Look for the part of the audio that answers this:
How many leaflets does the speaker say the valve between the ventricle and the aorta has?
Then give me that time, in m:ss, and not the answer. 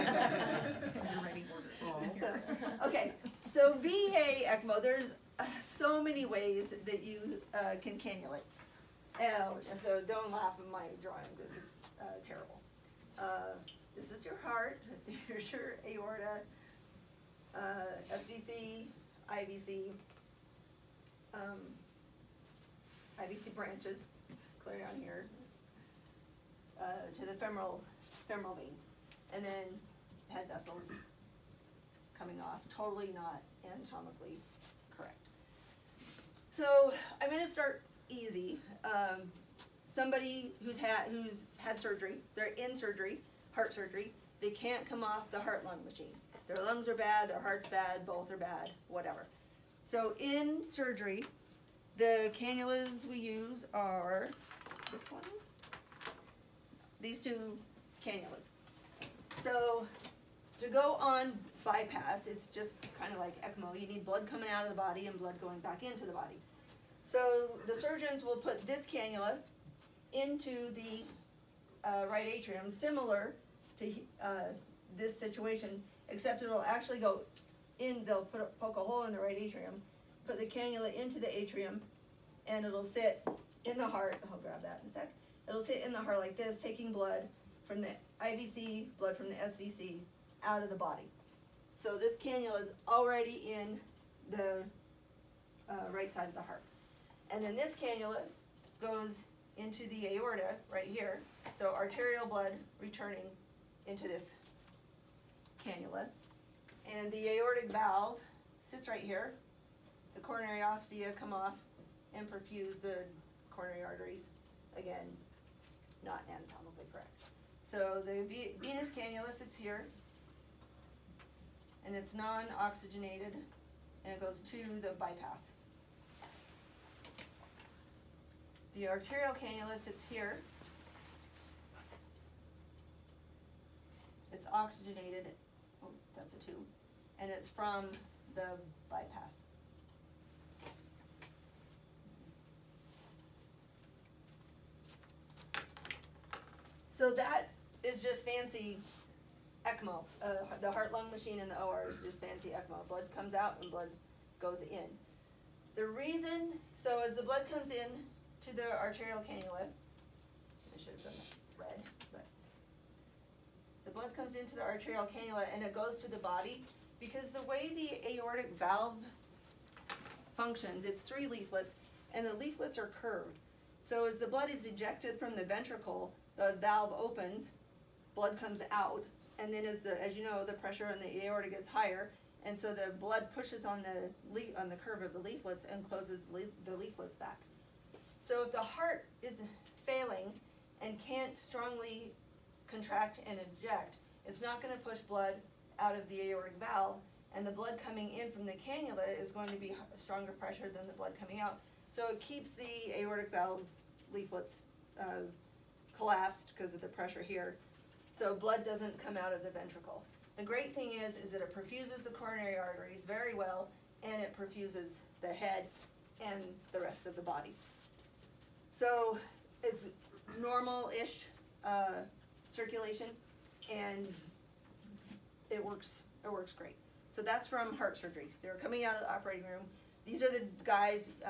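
2:51.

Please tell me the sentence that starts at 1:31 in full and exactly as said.
So this cannula is already in the uh, right side of the heart.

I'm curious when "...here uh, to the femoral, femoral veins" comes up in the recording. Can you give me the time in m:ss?
0:25.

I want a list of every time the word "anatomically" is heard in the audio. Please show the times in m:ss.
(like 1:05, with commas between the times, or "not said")
0:33, 1:56.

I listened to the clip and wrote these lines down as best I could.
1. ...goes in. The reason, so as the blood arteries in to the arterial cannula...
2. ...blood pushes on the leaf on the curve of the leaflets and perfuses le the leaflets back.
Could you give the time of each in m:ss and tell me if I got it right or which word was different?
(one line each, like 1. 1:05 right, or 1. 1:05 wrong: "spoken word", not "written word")
1. 2:34 wrong: "comes", not "arteries"
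2. 3:02 wrong: "closes", not "perfuses".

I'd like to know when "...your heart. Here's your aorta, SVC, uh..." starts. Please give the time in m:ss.
0:14.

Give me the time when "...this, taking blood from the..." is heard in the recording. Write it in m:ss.
1:26.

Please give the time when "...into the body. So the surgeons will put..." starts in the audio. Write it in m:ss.
1:05.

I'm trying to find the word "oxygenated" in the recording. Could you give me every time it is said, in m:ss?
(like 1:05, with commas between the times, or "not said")
2:02, 2:14.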